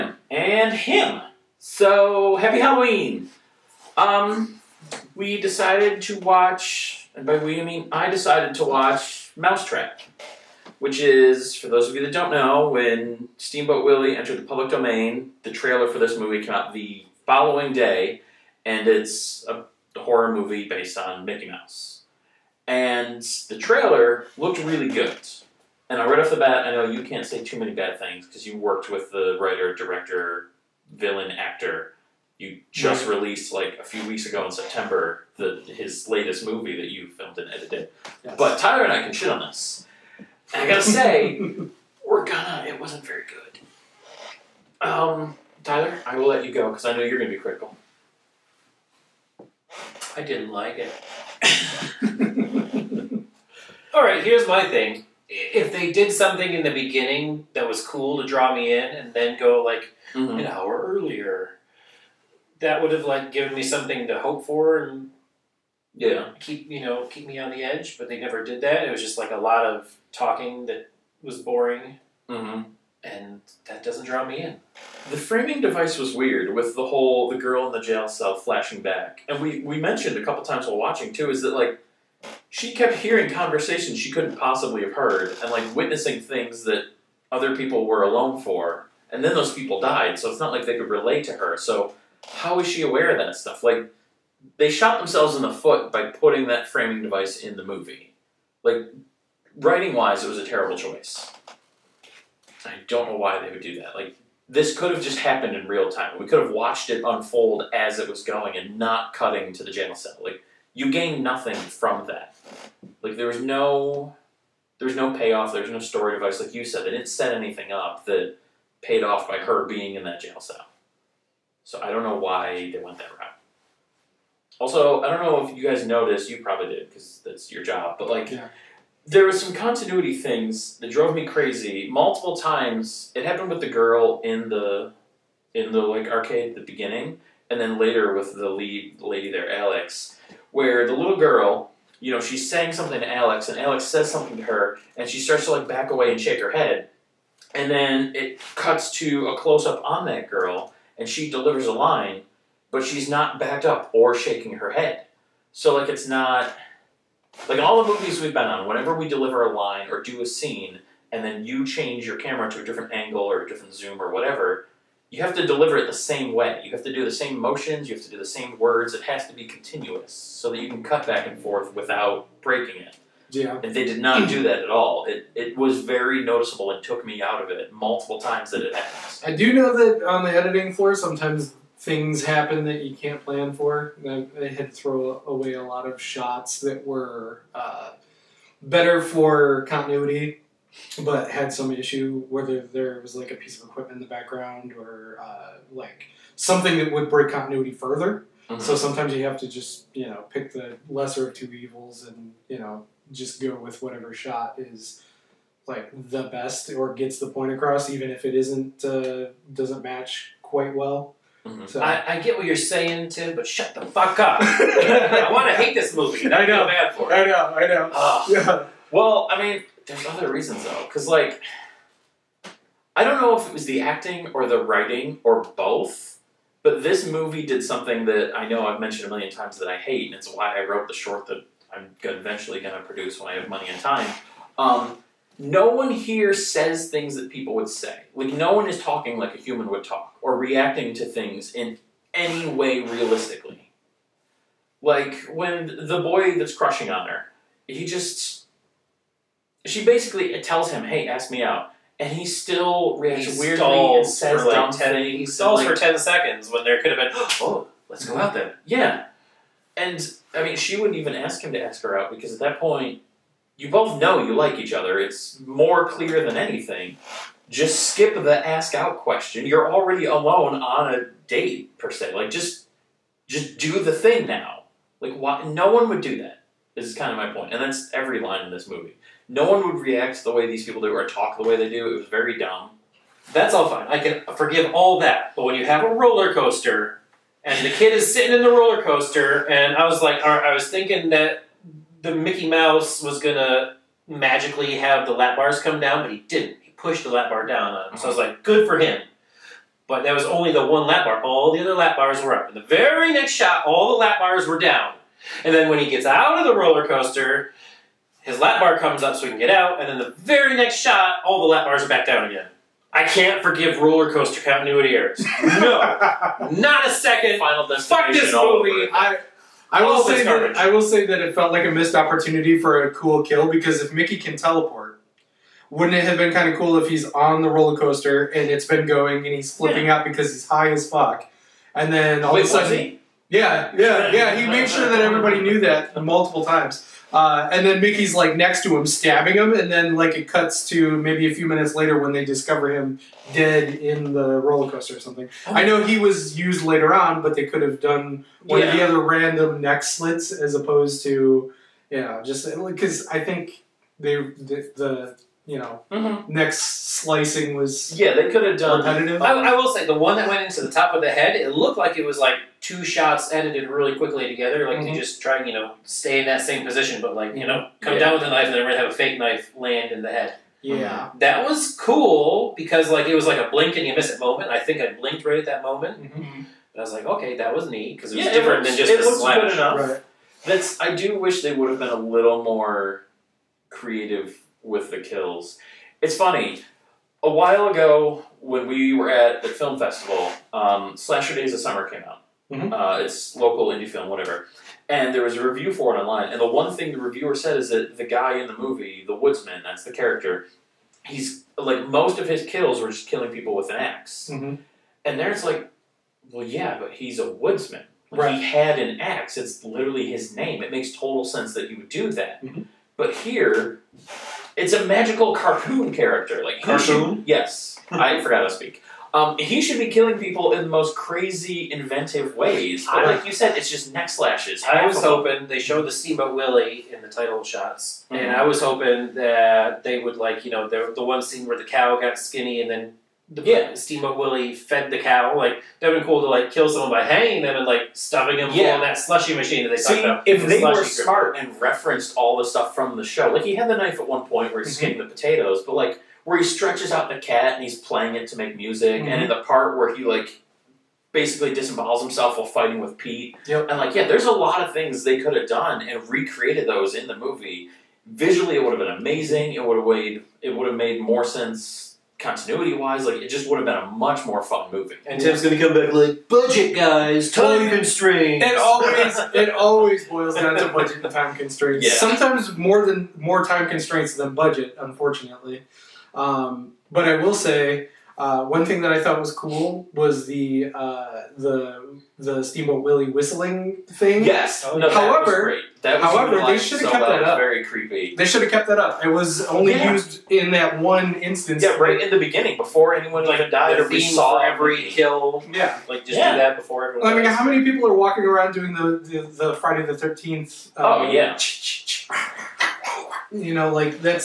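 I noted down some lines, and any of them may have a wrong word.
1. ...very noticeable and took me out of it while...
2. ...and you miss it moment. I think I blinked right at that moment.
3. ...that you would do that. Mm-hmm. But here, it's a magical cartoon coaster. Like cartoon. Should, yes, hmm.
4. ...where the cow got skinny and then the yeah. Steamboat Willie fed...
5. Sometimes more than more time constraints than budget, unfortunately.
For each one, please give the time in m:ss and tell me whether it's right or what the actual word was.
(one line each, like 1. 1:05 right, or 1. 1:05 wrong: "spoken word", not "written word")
1. 2:55 wrong: "multiple", not "while"
2. 6:13 right
3. 6:51 wrong: "character", not "coaster"
4. 7:11 right
5. 7:51 right.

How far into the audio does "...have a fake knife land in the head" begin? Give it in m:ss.
6:08.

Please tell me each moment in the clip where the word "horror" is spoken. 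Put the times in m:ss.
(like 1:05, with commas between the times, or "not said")
0:19.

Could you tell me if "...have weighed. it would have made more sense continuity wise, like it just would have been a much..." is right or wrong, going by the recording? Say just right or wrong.
right.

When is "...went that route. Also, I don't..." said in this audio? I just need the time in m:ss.
2:02.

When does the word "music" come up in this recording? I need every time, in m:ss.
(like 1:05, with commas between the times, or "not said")
7:28.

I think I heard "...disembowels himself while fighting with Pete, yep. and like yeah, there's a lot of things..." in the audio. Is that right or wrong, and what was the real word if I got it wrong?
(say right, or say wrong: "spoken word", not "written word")
right.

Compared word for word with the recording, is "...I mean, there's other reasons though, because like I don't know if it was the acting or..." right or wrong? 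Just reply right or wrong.
right.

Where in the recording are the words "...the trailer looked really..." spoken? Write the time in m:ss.
0:23.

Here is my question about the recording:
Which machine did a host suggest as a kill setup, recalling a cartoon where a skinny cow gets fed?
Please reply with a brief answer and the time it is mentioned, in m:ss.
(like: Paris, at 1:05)
slushy machine, at 7:18.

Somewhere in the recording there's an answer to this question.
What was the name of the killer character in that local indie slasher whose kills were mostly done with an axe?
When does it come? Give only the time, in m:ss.
6:39.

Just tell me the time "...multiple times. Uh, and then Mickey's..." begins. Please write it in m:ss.
5:36.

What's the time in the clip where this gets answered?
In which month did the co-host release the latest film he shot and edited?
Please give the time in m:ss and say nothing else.
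0:34.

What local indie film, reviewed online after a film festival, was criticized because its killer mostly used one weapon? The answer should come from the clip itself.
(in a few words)
Slasher Days of Summer.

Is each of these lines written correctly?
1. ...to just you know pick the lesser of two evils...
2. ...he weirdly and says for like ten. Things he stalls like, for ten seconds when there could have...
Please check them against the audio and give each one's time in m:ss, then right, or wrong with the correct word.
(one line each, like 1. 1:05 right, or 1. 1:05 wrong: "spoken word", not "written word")
1. 3:19 right
2. 4:13 right.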